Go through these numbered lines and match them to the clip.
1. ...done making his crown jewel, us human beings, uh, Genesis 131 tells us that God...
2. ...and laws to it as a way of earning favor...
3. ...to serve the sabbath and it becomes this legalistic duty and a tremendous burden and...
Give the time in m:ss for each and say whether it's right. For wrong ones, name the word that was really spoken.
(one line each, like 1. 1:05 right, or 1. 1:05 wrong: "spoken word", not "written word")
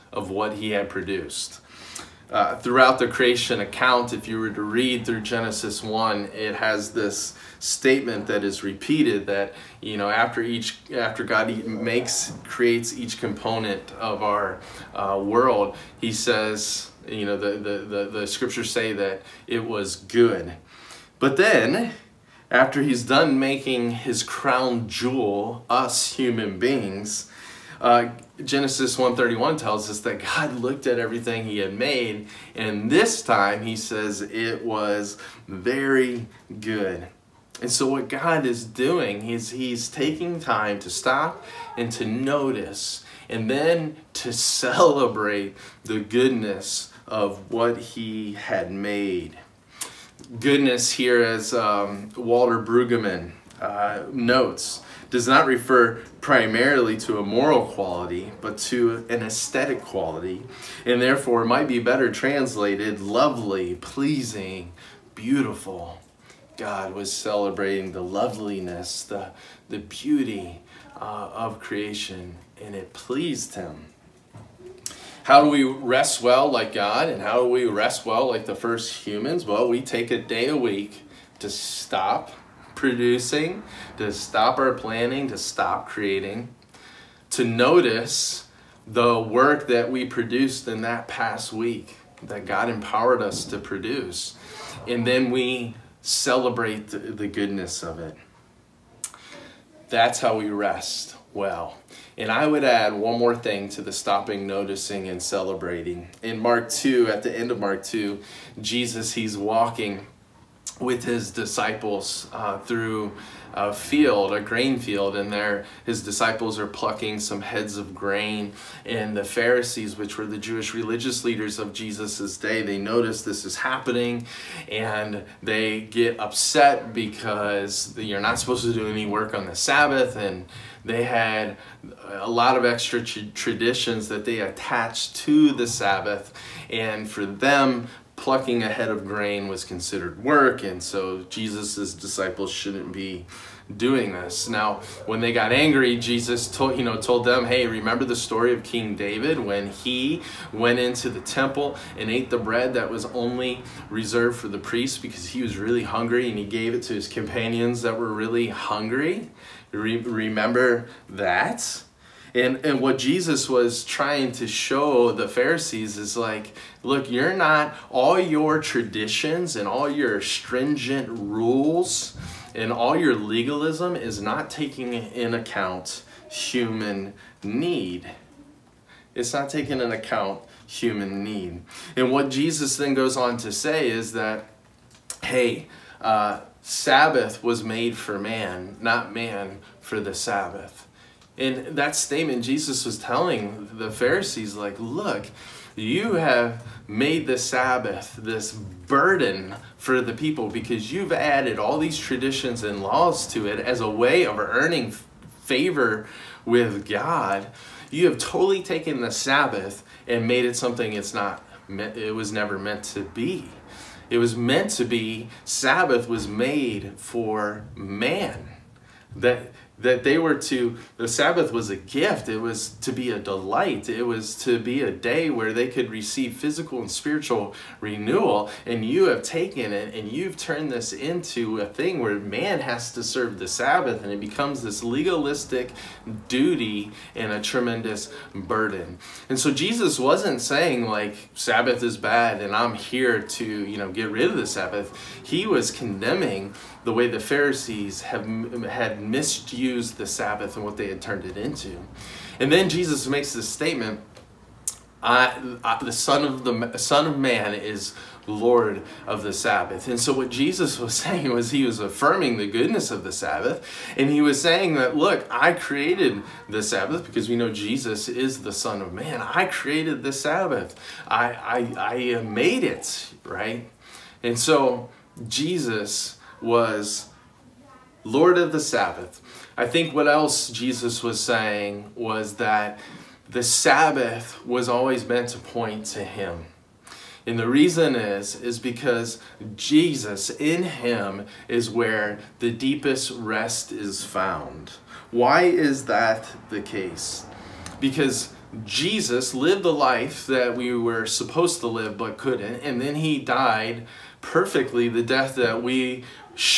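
1. 0:23 right
2. 3:22 right
3. 3:52 right.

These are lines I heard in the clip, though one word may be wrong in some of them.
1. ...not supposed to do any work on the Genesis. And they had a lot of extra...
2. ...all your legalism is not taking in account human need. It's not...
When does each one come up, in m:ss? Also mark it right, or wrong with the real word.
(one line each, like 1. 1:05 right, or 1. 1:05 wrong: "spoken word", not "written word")
1. 2:08 wrong: "Sabbath", not "Genesis"
2. 2:52 right.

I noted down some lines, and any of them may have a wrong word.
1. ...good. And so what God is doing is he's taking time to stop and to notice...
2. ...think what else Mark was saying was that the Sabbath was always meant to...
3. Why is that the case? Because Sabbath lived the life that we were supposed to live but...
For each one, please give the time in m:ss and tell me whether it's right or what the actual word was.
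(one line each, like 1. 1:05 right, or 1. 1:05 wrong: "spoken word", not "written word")
1. 0:36 right
2. 4:39 wrong: "Jesus", not "Mark"
3. 4:55 wrong: "Jesus", not "Sabbath".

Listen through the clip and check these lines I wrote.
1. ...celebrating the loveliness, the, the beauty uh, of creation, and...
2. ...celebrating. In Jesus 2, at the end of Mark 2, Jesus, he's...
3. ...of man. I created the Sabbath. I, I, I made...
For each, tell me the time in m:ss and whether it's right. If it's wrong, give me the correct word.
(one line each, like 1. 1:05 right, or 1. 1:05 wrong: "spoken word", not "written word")
1. 1:07 right
2. 1:45 wrong: "Mark", not "Jesus"
3. 4:28 right.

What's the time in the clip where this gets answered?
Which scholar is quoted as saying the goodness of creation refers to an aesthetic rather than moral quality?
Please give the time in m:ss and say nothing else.
0:52.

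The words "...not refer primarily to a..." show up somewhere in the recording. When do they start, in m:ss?
0:55.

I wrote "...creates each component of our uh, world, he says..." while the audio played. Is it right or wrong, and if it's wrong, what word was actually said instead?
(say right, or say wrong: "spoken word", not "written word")
right.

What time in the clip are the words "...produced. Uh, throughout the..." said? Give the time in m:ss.
0:00.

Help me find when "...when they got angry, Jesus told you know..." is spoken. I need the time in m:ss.
2:25.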